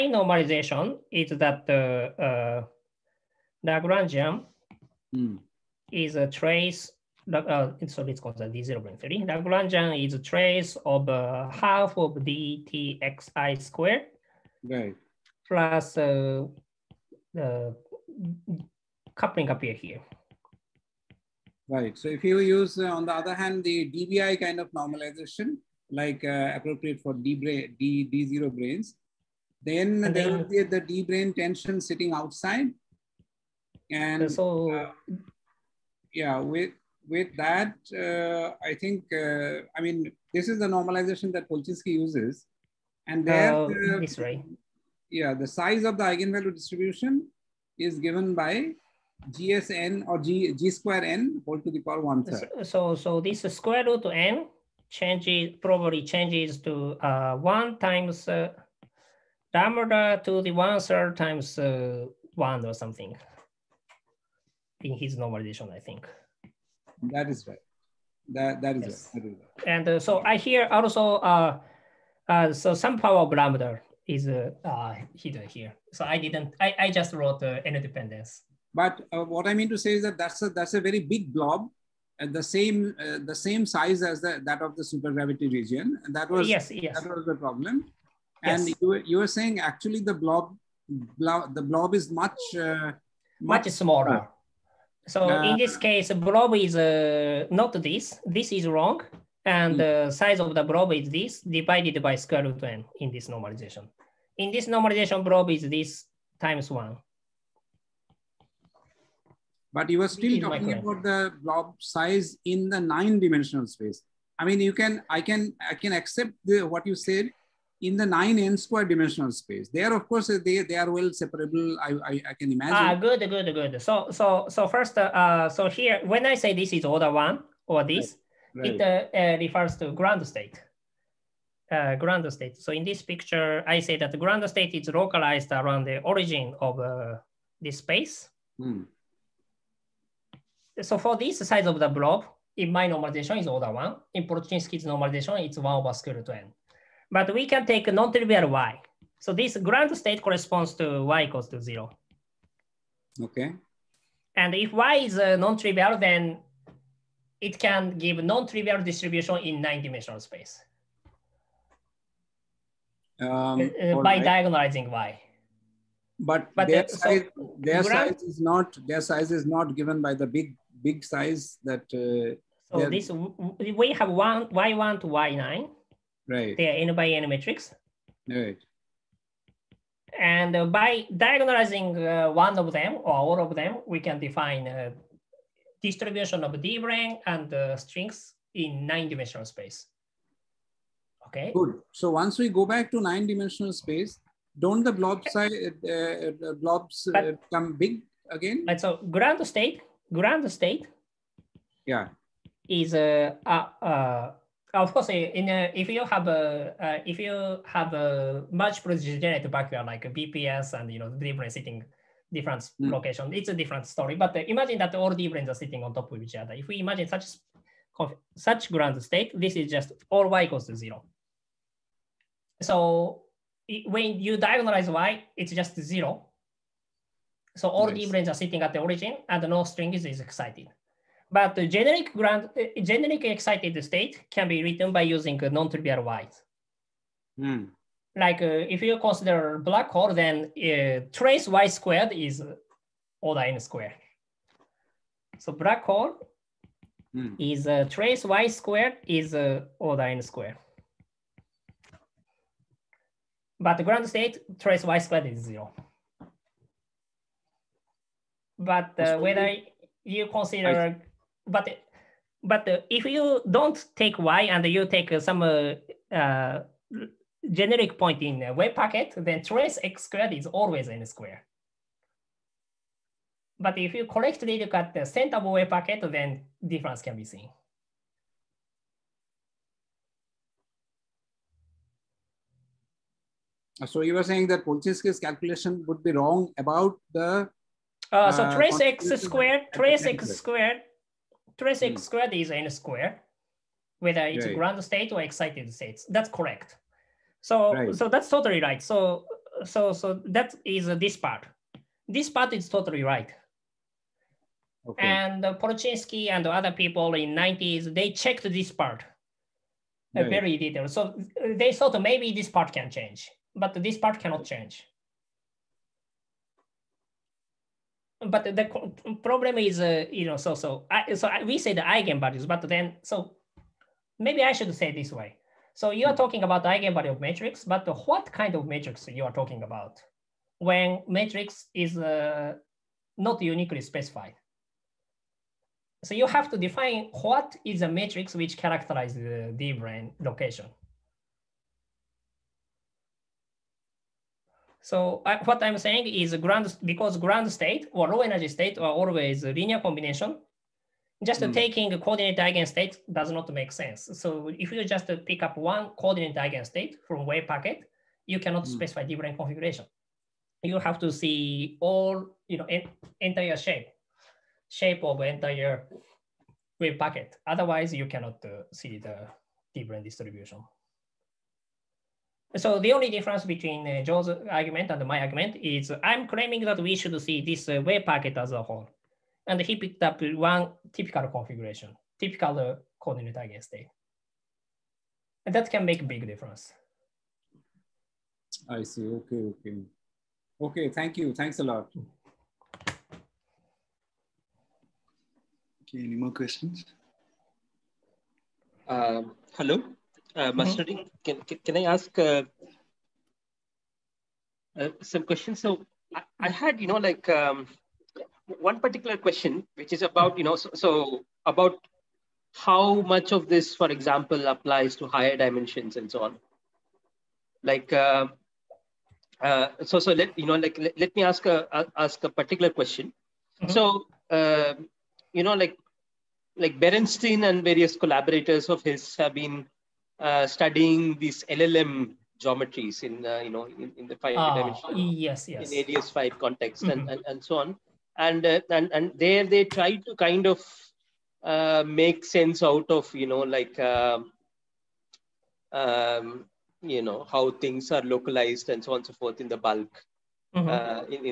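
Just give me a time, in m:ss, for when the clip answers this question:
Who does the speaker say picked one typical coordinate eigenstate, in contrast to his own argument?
6:14.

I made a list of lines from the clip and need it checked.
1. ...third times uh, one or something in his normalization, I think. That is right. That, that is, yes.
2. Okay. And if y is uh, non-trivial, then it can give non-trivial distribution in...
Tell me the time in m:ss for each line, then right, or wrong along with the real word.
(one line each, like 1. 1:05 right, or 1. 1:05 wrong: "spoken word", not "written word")
1. 1:00 right
2. 2:33 right.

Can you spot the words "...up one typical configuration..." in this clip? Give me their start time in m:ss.
6:20.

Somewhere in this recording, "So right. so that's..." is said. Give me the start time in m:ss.
4:57.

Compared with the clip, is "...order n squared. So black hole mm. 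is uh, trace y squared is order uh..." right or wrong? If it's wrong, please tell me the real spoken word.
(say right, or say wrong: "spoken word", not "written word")
right.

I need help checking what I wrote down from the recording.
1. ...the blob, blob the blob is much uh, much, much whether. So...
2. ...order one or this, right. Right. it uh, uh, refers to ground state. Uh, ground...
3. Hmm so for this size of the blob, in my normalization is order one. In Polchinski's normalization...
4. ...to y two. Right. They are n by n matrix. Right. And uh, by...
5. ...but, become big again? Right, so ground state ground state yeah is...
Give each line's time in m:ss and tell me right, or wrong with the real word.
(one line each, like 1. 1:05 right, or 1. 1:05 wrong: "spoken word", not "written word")
1. 1:29 wrong: "smaller", not "whether"
2. 2:06 right
3. 2:18 right
4. 2:54 wrong: "nine", not "two"
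5. 3:17 right.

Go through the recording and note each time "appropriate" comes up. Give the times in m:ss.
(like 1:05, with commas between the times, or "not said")
0:26.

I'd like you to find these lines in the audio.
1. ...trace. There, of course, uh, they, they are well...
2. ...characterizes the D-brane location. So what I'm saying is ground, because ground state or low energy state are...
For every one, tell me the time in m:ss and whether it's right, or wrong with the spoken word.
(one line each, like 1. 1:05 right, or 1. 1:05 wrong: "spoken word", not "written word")
1. 1:59 wrong: "space", not "trace"
2. 5:38 right.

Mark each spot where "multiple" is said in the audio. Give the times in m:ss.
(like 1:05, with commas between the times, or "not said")
3:28.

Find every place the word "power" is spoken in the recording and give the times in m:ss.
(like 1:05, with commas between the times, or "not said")
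0:51, 1:12.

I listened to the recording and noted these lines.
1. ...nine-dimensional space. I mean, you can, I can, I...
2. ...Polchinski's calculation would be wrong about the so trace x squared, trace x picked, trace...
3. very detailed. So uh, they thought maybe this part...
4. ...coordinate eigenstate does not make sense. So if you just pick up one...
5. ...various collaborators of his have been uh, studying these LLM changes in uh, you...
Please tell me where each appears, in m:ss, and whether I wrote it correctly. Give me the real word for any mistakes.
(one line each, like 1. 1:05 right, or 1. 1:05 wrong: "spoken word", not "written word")
1. 1:52 right
2. 4:44 wrong: "squared", not "picked"
3. 5:10 right
4. 5:51 right
5. 7:07 wrong: "geometries", not "changes".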